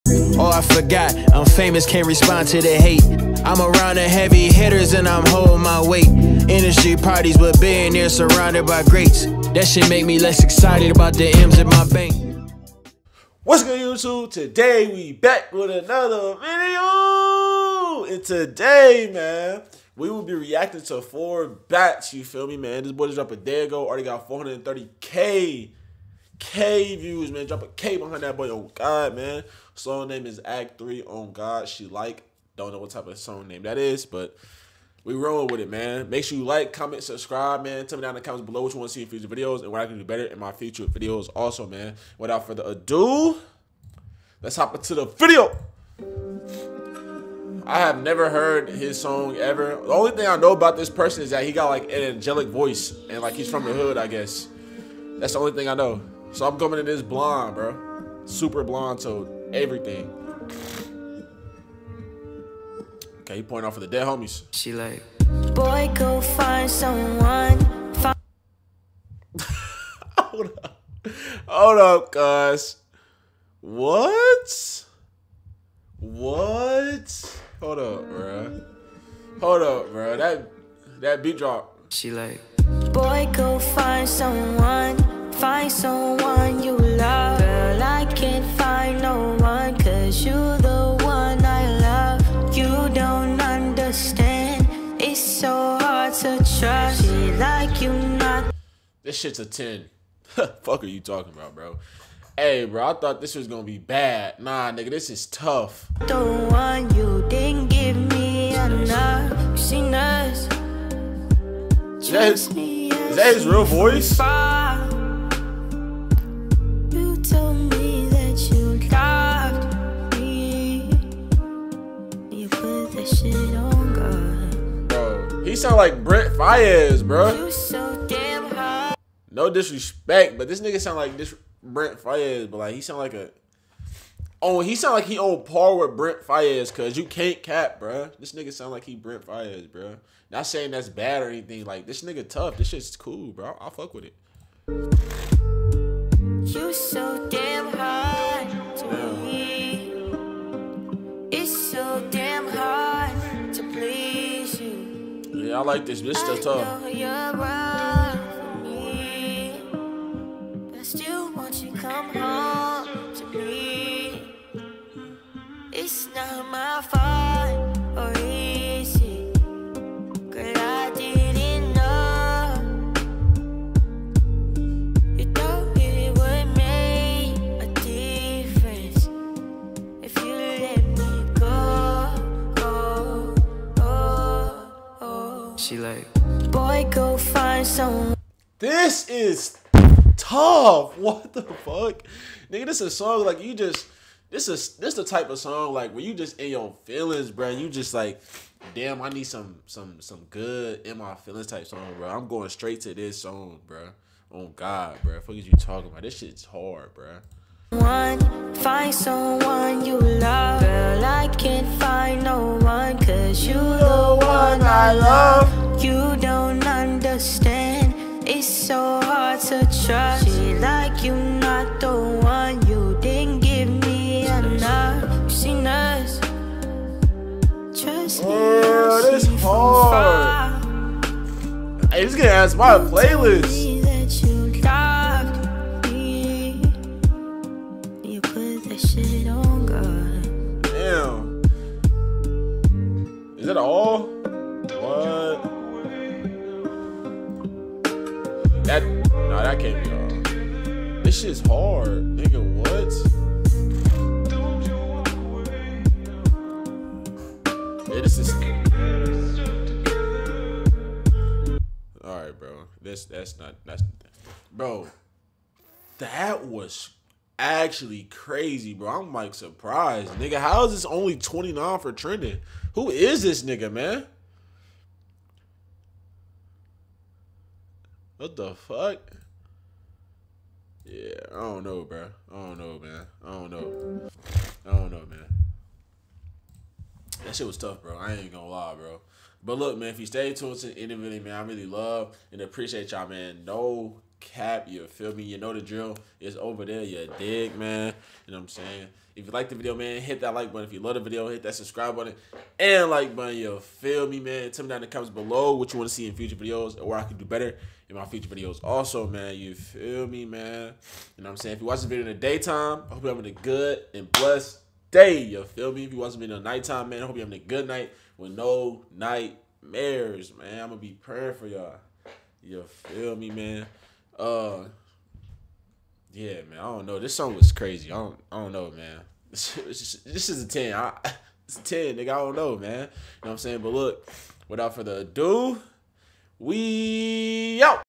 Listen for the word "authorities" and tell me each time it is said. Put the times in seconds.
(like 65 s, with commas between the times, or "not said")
not said.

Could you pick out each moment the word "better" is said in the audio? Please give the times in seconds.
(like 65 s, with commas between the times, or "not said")
40 s, 307 s.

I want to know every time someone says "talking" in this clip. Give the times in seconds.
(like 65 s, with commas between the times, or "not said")
100 s, 205 s.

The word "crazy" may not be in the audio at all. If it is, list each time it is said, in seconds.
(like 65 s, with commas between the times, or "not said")
268 s, 327 s.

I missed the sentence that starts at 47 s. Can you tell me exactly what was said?
I have never heard his song ever.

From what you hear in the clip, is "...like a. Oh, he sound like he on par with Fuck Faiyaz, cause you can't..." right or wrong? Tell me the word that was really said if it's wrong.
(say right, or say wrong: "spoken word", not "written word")
wrong: "Brent", not "Fuck".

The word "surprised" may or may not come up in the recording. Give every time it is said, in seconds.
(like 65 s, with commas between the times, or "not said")
269 s.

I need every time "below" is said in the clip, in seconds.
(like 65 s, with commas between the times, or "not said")
38 s, 305 s.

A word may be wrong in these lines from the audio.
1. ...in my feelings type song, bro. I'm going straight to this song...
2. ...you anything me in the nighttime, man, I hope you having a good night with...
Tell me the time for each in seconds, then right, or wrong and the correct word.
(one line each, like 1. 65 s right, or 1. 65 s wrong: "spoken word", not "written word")
1. 200 s right
2. 315 s wrong: "watching", not "anything".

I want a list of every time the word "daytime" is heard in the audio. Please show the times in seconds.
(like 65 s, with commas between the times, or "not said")
312 s.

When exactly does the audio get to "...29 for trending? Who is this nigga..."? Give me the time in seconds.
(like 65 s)
271 s.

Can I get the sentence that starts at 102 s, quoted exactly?
Hey, bro, I thought this was gonna be bad.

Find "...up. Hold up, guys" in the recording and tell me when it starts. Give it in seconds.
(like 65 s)
70 s.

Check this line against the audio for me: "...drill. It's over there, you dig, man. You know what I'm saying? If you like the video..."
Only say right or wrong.
right.